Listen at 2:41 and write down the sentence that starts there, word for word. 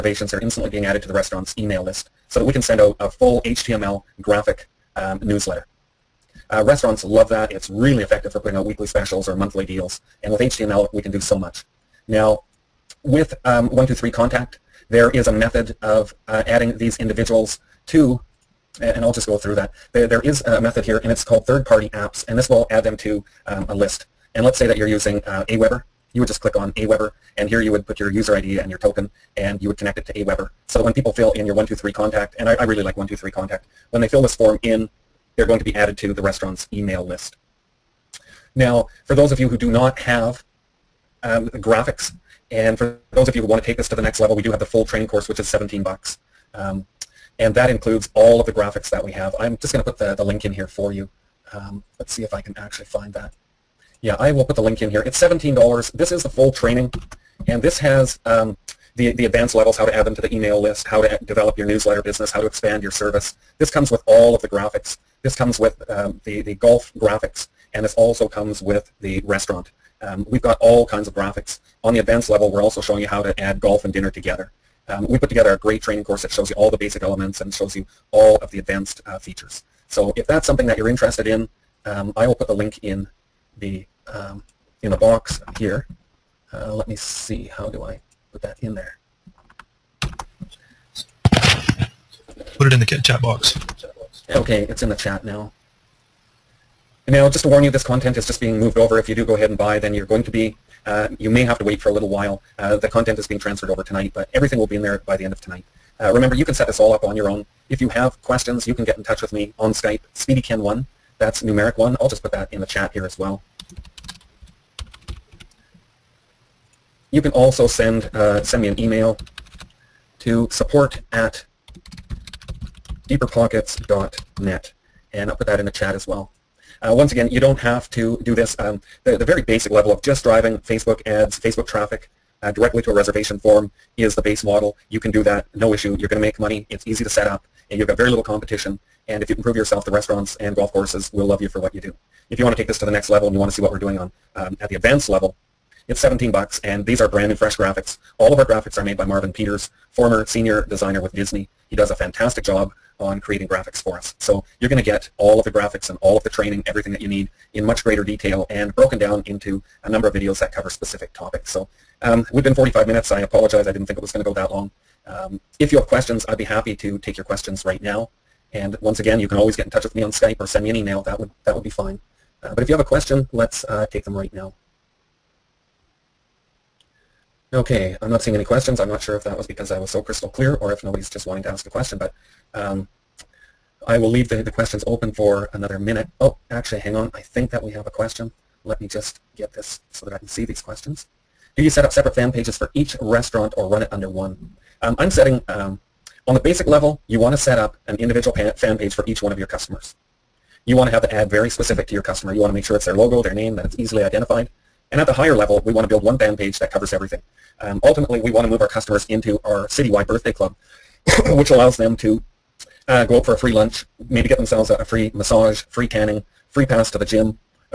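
So um, we've been 45 minutes.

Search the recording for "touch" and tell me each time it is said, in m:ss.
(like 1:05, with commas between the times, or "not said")
1:49, 2:49.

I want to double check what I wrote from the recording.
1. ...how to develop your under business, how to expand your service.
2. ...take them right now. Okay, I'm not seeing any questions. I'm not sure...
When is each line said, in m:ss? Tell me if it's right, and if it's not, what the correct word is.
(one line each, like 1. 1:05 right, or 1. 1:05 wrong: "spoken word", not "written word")
1. 1:00 wrong: "newsletter", not "under"
2. 2:53 right.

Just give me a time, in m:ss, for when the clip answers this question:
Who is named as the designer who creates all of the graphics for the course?
2:29.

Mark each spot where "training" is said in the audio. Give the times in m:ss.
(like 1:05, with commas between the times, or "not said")
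0:44, 0:56, 1:15, 2:36.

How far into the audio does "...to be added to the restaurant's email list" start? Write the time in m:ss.
0:35.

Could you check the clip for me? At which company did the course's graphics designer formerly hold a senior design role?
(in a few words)
Disney.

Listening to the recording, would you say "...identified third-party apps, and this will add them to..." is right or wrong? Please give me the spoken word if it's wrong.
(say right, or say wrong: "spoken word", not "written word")
wrong: "called", not "identified".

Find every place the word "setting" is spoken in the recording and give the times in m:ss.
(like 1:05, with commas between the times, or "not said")
3:15.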